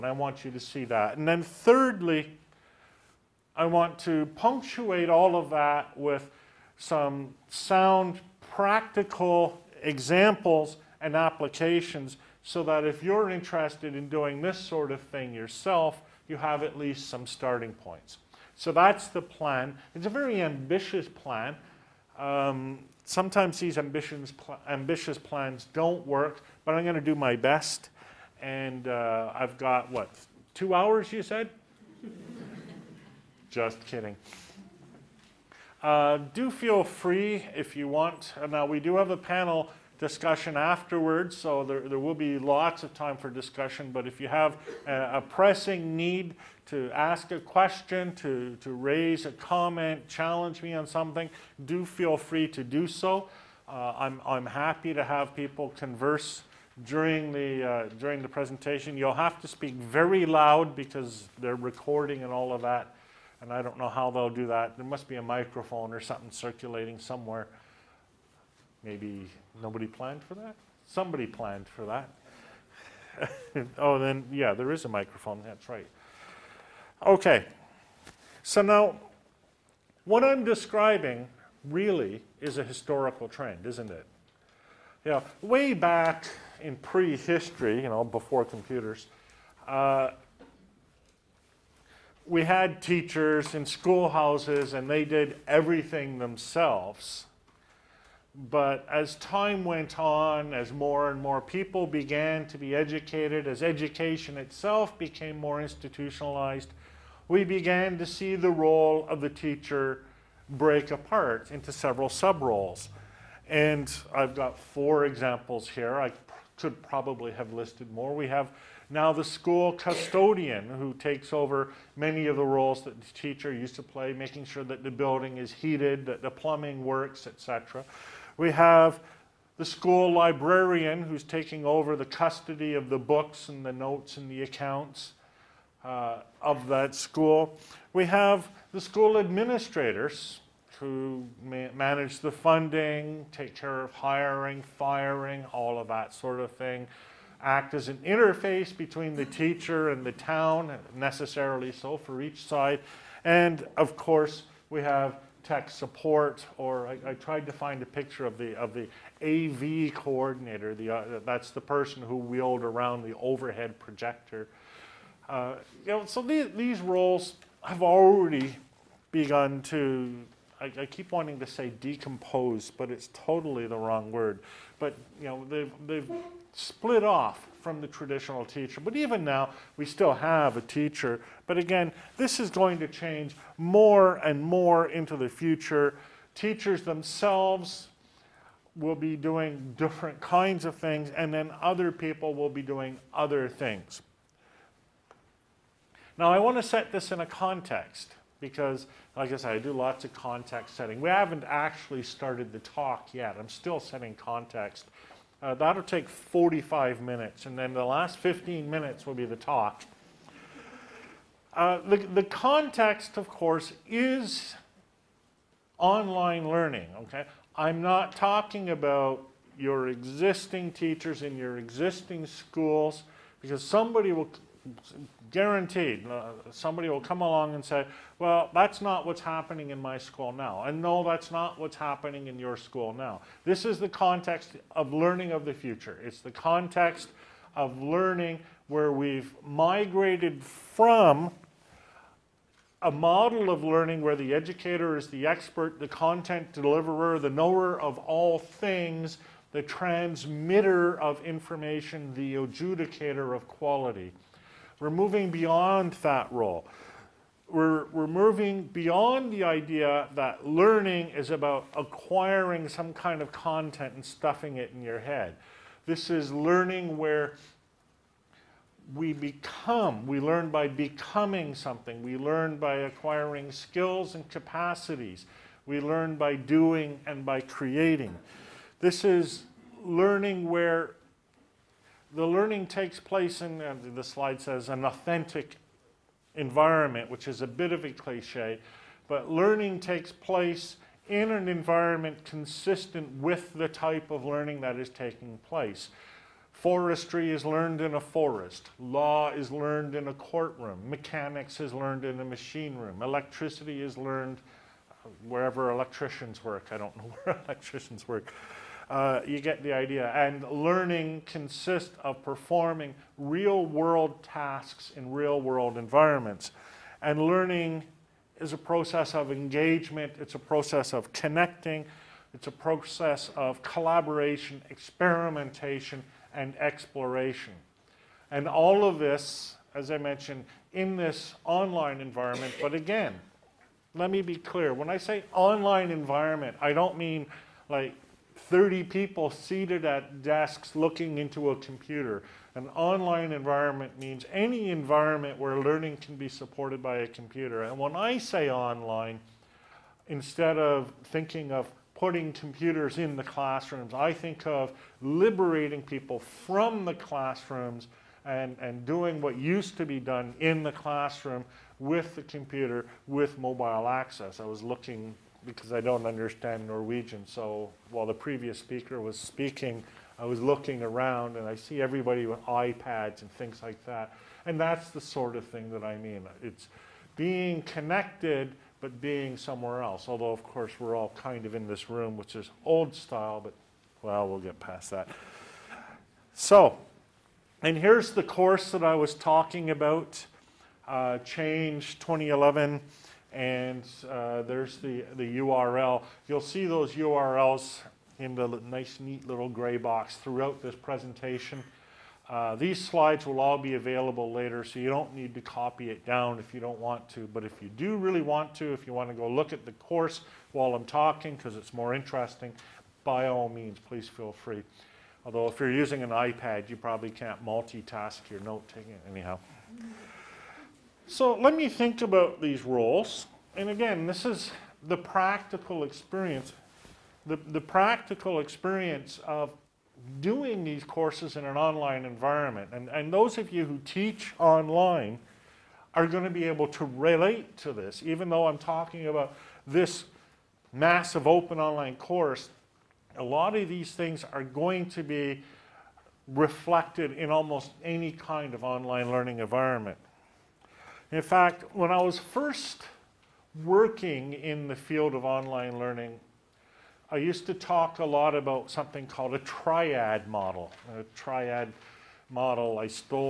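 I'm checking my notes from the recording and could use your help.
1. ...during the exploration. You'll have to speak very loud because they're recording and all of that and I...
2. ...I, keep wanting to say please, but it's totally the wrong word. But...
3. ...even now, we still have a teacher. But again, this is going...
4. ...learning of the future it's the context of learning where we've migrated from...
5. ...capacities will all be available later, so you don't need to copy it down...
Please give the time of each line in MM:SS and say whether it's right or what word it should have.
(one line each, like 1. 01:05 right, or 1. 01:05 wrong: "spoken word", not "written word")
1. 00:57 wrong: "presentation", not "exploration"
2. 02:50 wrong: "decompose", not "please"
3. 02:58 right
4. 03:54 right
5. 06:42 wrong: "slides", not "capacities".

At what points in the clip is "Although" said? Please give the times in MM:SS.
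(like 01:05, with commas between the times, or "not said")
06:20, 06:55.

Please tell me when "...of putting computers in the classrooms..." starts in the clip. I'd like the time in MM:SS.
05:51.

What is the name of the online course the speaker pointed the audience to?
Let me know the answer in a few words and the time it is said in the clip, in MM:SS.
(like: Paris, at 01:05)
Change 2011, at 06:31.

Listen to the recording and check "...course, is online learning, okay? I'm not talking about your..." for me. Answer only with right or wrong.
right.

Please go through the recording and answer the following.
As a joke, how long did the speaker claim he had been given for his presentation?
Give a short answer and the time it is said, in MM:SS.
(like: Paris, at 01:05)
2 hours, at 00:30.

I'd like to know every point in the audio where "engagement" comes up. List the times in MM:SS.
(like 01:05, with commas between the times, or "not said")
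05:19.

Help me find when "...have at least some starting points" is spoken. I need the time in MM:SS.
00:16.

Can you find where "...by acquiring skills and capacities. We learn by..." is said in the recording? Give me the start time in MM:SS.
04:32.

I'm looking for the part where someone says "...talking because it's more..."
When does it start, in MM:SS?
06:50.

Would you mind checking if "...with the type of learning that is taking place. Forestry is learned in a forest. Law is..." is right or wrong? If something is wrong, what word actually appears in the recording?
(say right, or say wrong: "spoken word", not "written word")
right.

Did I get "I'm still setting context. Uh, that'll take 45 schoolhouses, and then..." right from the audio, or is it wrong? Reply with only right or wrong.
wrong.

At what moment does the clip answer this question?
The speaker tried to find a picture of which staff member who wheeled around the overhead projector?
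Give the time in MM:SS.
02:39.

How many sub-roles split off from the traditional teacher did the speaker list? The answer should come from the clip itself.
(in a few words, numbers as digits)
4.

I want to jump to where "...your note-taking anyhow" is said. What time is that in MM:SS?
06:58.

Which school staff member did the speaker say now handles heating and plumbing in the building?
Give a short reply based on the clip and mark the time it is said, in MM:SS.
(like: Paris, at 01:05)
School custodian, at 01:59.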